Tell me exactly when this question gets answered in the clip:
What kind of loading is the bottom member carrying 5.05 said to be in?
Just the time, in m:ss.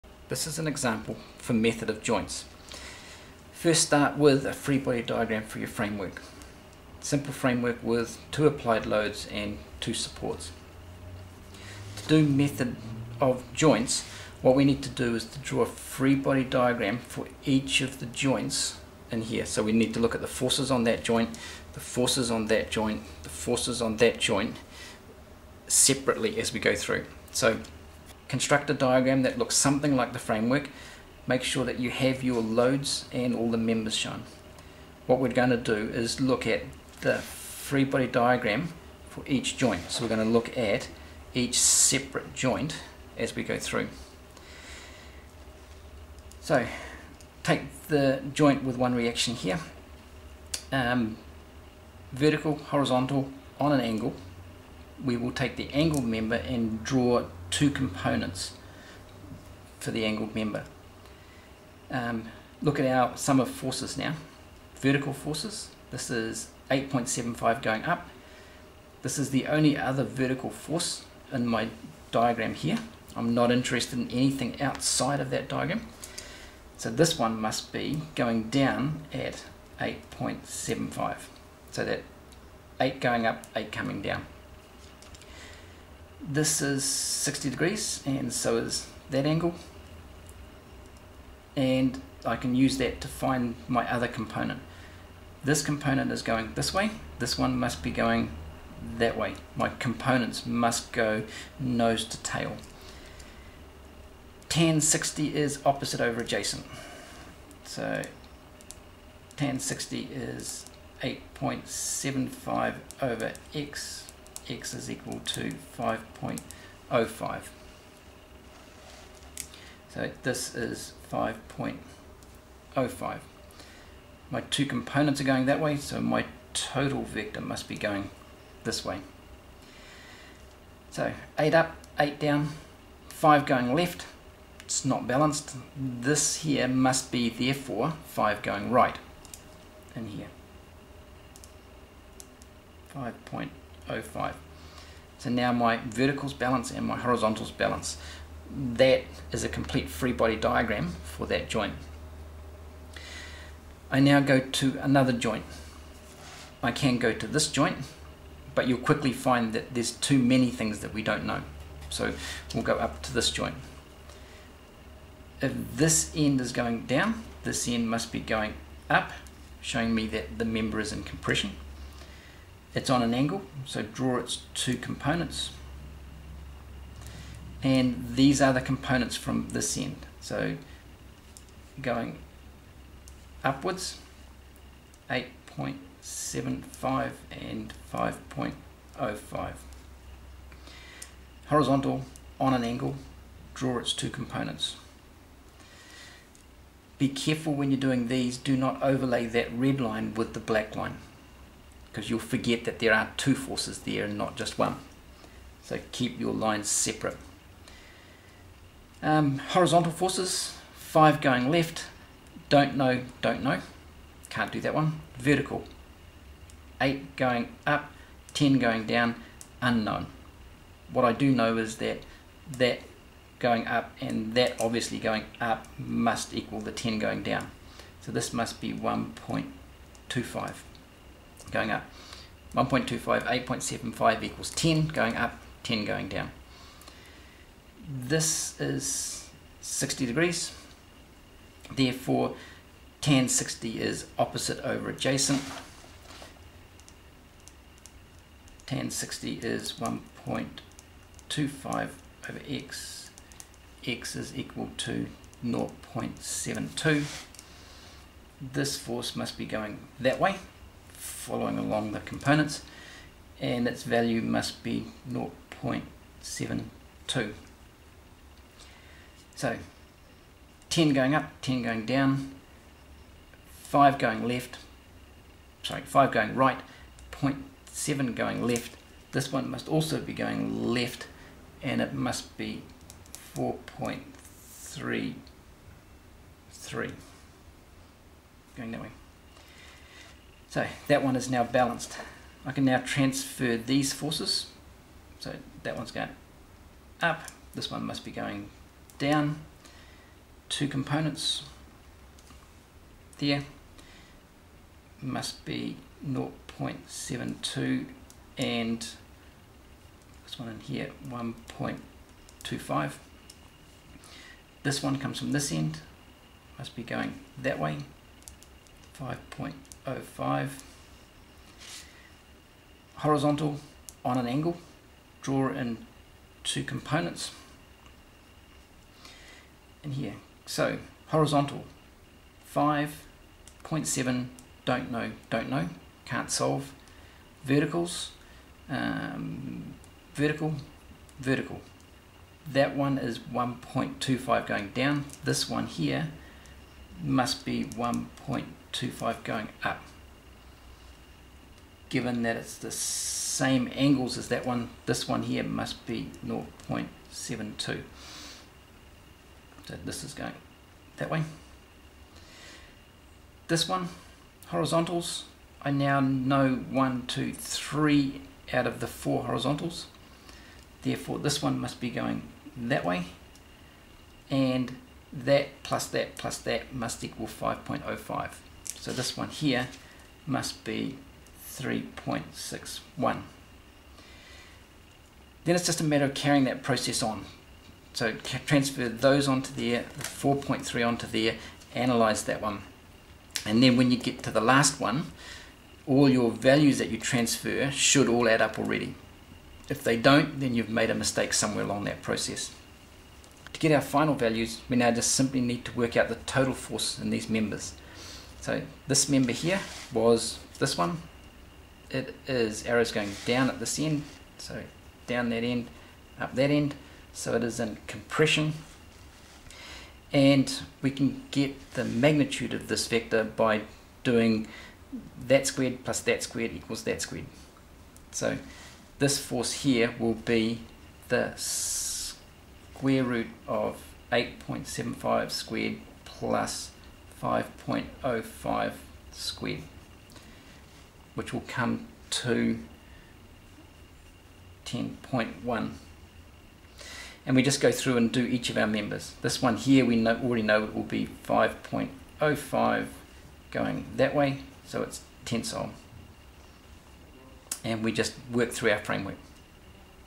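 7:34.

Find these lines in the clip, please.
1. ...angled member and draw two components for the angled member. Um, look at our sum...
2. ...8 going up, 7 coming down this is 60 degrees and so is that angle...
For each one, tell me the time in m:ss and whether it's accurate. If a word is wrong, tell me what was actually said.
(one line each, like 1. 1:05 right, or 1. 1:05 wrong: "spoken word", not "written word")
1. 0:55 right
2. 1:22 wrong: "8", not "7".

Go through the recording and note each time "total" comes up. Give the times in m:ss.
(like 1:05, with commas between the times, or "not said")
2:06, 6:46.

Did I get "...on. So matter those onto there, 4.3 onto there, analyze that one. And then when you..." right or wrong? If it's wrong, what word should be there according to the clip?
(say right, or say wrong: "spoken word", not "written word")
wrong: "transfer", not "matter".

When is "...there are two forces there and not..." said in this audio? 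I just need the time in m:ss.
3:22.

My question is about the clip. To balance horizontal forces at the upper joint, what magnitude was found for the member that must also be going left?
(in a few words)
4.33.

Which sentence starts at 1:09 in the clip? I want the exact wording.
This is the only other vertical force in my diagram here.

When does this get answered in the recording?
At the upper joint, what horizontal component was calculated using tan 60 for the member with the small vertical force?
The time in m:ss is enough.
4:13.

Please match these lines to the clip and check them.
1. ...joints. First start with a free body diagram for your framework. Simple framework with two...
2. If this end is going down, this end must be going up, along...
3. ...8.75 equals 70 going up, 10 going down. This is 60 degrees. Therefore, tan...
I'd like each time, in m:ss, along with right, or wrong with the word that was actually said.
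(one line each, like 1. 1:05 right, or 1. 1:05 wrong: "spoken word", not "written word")
1. 0:02 right
2. 2:45 wrong: "showing", not "along"
3. 3:53 wrong: "10", not "70".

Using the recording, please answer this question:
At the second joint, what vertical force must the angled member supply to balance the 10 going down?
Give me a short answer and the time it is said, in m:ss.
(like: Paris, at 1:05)
1.25, at 3:48.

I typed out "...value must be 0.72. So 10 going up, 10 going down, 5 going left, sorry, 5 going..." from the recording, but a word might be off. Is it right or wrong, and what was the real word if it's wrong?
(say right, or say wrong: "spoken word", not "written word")
right.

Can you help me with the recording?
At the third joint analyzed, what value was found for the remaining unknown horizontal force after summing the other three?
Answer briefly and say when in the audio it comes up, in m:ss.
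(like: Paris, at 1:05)
3.61, at 6:18.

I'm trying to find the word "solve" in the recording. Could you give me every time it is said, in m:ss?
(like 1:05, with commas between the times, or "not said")
5:36.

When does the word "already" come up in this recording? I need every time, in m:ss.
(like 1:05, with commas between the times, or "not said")
6:38, 7:30.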